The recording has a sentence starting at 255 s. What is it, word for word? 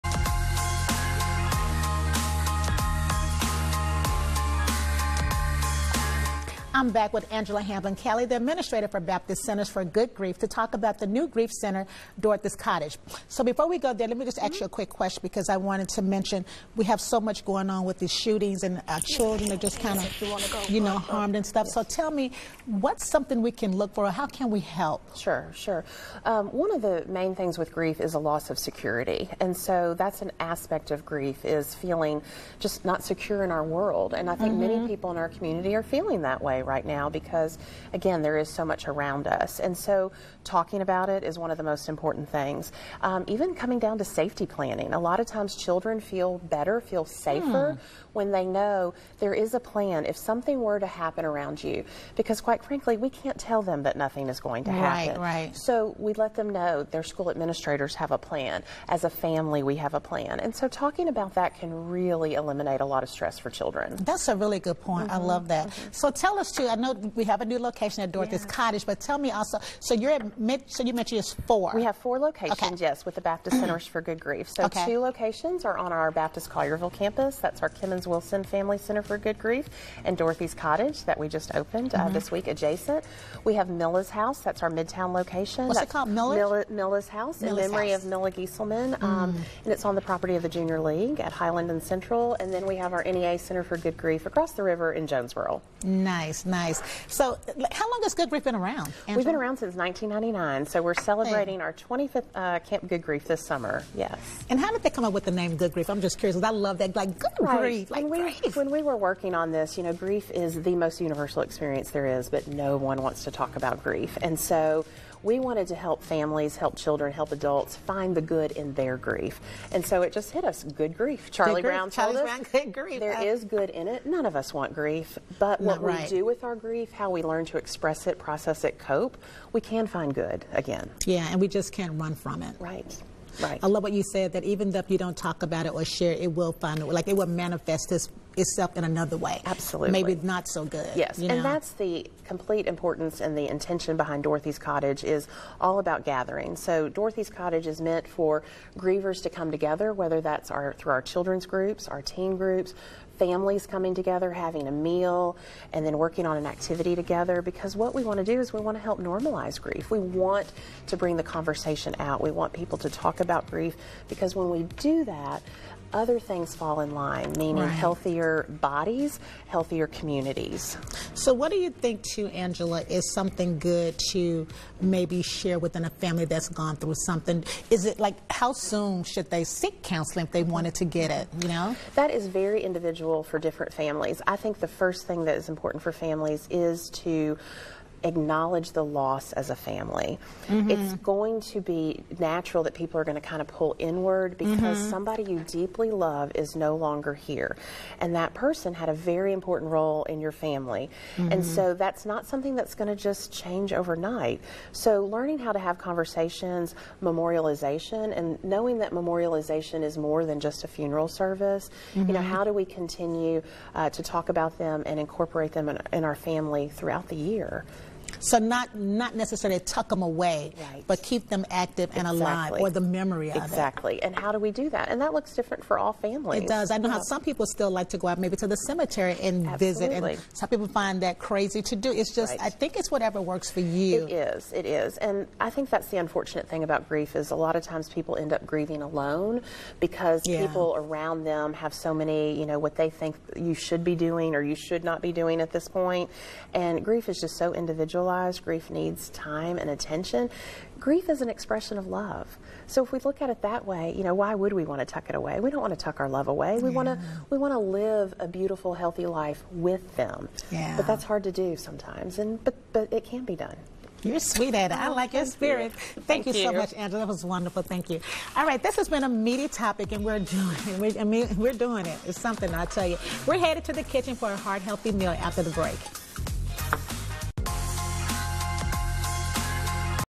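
We don't want to tuck our love away.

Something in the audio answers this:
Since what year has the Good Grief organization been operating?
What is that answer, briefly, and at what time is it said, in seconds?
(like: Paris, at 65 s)
1999, at 99 s.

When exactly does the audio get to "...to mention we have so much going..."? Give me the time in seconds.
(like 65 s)
15 s.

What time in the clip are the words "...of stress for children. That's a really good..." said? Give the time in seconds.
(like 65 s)
63 s.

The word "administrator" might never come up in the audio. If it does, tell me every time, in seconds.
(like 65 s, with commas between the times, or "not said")
8 s, 57 s.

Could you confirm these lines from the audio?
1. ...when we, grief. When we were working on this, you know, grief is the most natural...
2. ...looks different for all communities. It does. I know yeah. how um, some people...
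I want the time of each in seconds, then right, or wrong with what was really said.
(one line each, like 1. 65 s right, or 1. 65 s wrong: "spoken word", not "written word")
1. 108 s wrong: "universal", not "natural"
2. 225 s wrong: "families", not "communities".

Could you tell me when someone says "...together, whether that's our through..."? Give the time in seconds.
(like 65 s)
149 s.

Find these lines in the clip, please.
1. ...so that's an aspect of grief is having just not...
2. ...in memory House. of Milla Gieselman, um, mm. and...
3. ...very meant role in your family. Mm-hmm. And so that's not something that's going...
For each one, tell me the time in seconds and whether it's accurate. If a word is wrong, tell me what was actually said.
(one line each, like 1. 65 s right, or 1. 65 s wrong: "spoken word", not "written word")
1. 29 s wrong: "feeling", not "having"
2. 87 s right
3. 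198 s wrong: "important", not "meant".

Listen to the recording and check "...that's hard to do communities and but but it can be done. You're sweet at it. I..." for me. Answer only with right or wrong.
wrong.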